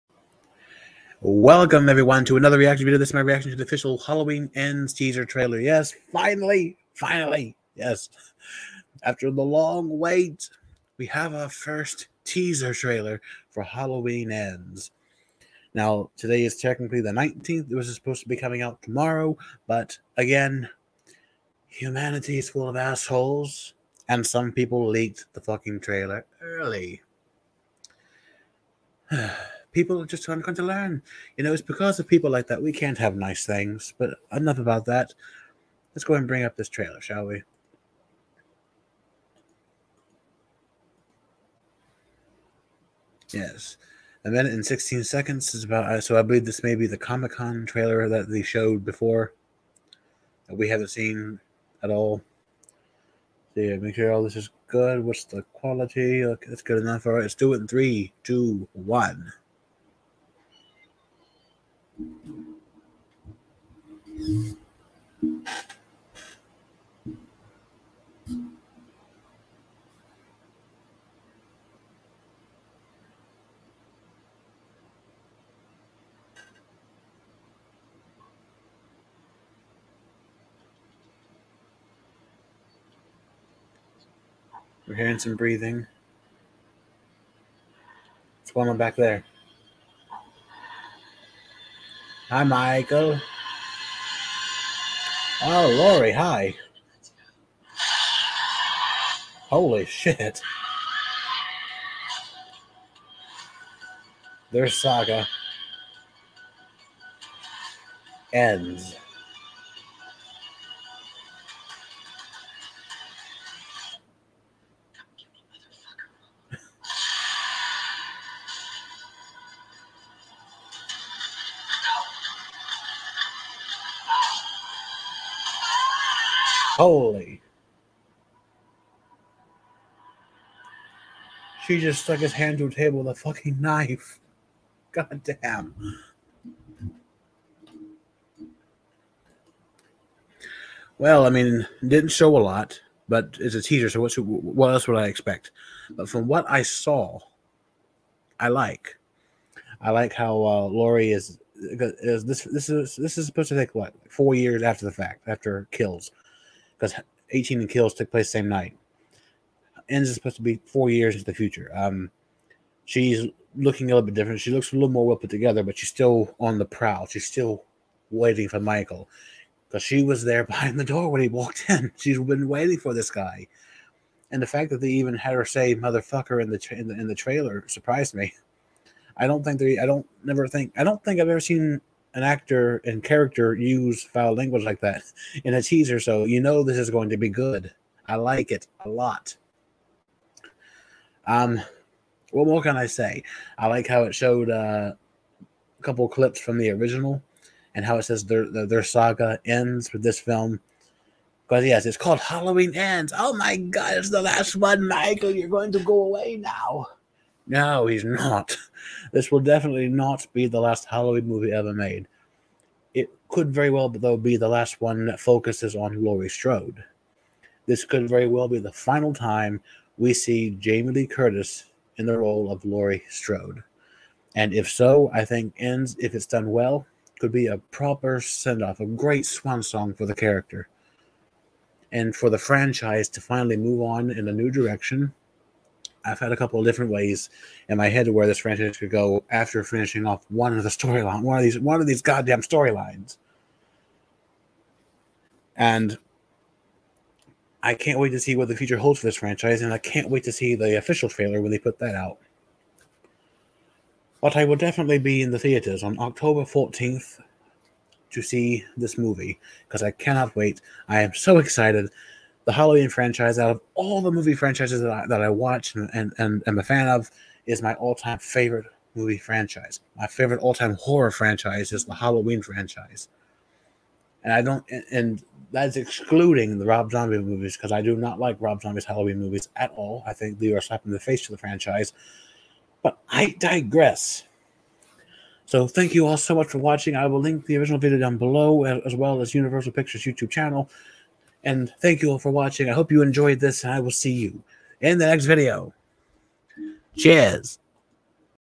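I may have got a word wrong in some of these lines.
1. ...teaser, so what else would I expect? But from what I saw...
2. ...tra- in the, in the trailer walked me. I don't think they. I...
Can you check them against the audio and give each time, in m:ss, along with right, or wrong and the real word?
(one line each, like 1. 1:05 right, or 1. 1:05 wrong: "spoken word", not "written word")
1. 2:23 right
2. 2:56 wrong: "surprised", not "walked".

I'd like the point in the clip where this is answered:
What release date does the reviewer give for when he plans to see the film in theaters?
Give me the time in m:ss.
4:15.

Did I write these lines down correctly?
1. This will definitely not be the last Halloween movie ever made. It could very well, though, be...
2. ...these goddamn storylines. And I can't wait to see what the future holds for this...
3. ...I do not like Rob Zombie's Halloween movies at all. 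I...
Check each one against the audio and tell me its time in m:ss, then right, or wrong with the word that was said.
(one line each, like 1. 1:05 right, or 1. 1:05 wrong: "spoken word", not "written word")
1. 3:29 right
2. 4:01 right
3. 4:37 right.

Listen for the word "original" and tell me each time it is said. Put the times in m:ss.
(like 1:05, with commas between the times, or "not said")
3:16, 4:47.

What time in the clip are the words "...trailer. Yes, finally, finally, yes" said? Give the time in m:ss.
0:05.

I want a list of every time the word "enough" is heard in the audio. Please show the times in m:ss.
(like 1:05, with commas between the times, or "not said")
0:34, 0:56.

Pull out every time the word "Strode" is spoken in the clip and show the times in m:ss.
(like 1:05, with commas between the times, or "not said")
3:36, 3:43.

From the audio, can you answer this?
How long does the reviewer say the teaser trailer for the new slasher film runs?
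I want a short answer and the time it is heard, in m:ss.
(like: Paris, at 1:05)
1 minute 16 seconds, at 0:44.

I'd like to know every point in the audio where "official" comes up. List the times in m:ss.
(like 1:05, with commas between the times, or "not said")
0:03, 4:10.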